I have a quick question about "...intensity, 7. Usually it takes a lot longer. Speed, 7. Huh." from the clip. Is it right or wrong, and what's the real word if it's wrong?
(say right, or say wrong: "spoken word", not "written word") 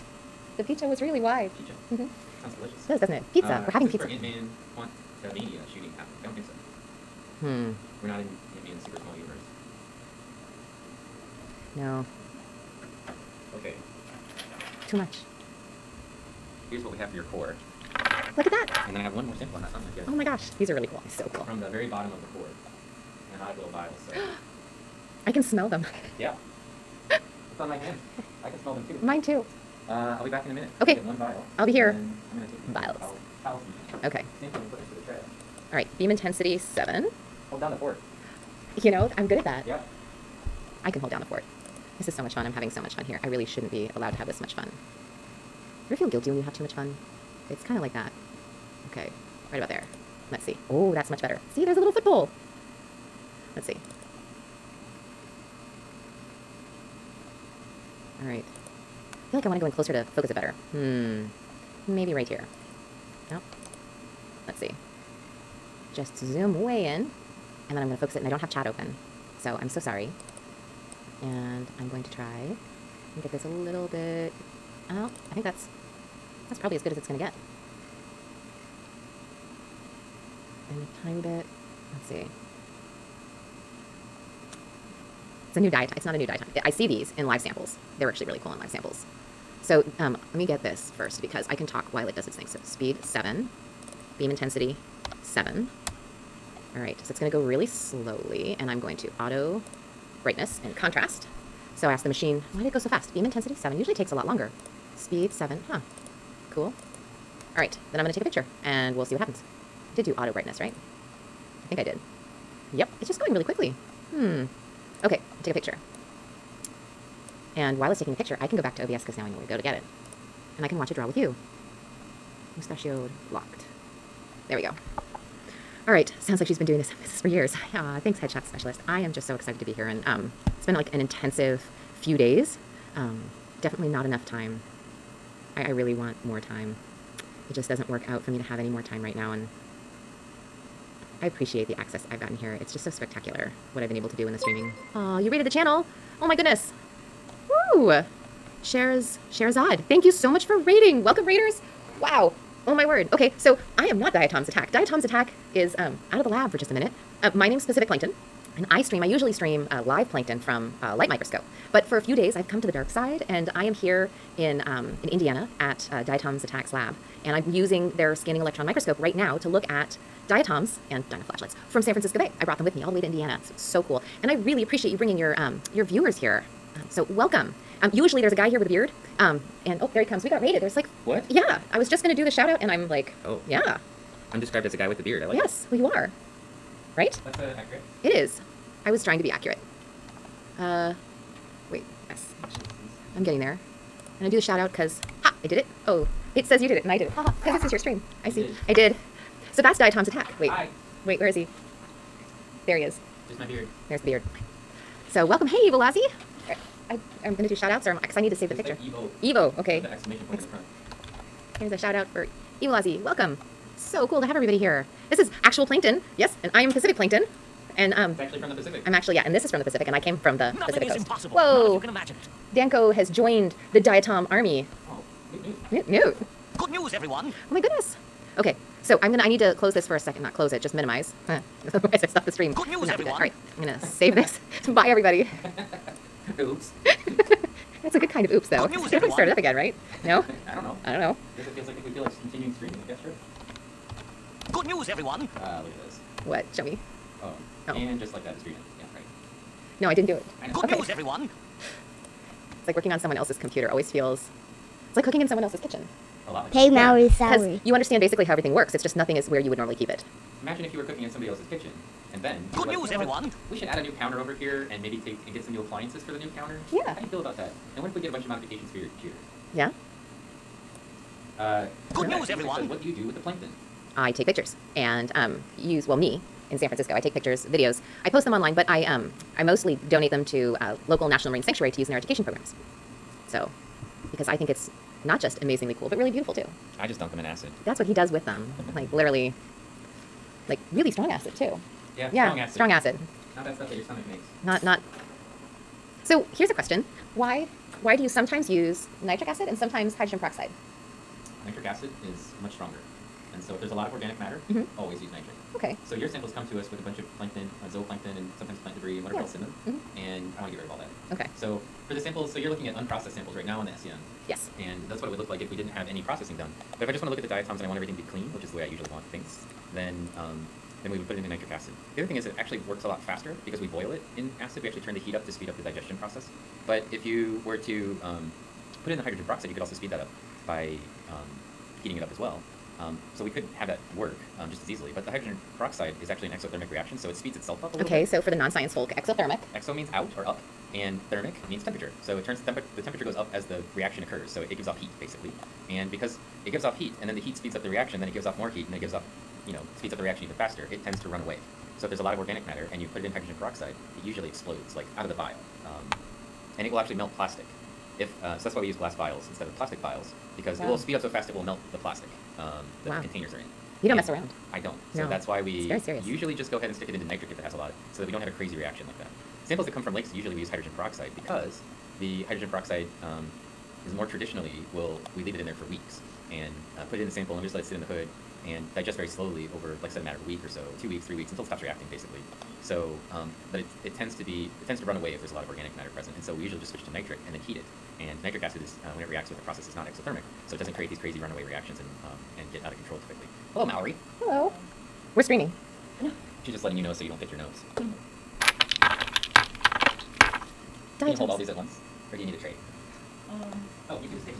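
right.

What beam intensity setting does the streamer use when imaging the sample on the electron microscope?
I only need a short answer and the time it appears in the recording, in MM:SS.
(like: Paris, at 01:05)
7, at 00:35.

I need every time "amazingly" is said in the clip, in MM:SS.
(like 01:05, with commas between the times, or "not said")
04:45.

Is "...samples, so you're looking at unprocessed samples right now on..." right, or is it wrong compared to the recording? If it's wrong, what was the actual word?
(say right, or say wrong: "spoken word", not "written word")
right.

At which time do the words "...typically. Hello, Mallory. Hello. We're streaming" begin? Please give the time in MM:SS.
06:33.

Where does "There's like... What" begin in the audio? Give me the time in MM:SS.
03:00.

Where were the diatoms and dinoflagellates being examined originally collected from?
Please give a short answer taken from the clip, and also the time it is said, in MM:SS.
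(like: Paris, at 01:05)
San Francisco Bay, at 02:51.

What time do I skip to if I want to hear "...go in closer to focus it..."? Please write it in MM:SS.
00:59.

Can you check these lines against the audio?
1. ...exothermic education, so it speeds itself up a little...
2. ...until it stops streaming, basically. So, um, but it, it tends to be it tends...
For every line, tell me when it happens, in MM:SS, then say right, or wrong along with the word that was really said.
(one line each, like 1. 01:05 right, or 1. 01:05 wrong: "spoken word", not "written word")
1. 05:36 wrong: "reaction", not "education"
2. 06:21 wrong: "reacting", not "streaming".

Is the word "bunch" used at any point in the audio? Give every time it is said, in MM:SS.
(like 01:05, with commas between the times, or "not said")
04:28, 05:06.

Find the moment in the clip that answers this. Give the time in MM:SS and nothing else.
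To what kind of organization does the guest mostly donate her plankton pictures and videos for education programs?
04:41.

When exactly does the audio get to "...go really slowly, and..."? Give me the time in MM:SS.
01:37.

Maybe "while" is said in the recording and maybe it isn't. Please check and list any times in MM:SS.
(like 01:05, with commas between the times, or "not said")
01:31, 01:57.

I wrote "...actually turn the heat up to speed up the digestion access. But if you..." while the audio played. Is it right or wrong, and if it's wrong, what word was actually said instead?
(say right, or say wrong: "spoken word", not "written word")
wrong: "process", not "access".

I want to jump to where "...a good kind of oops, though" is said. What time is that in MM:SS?
03:57.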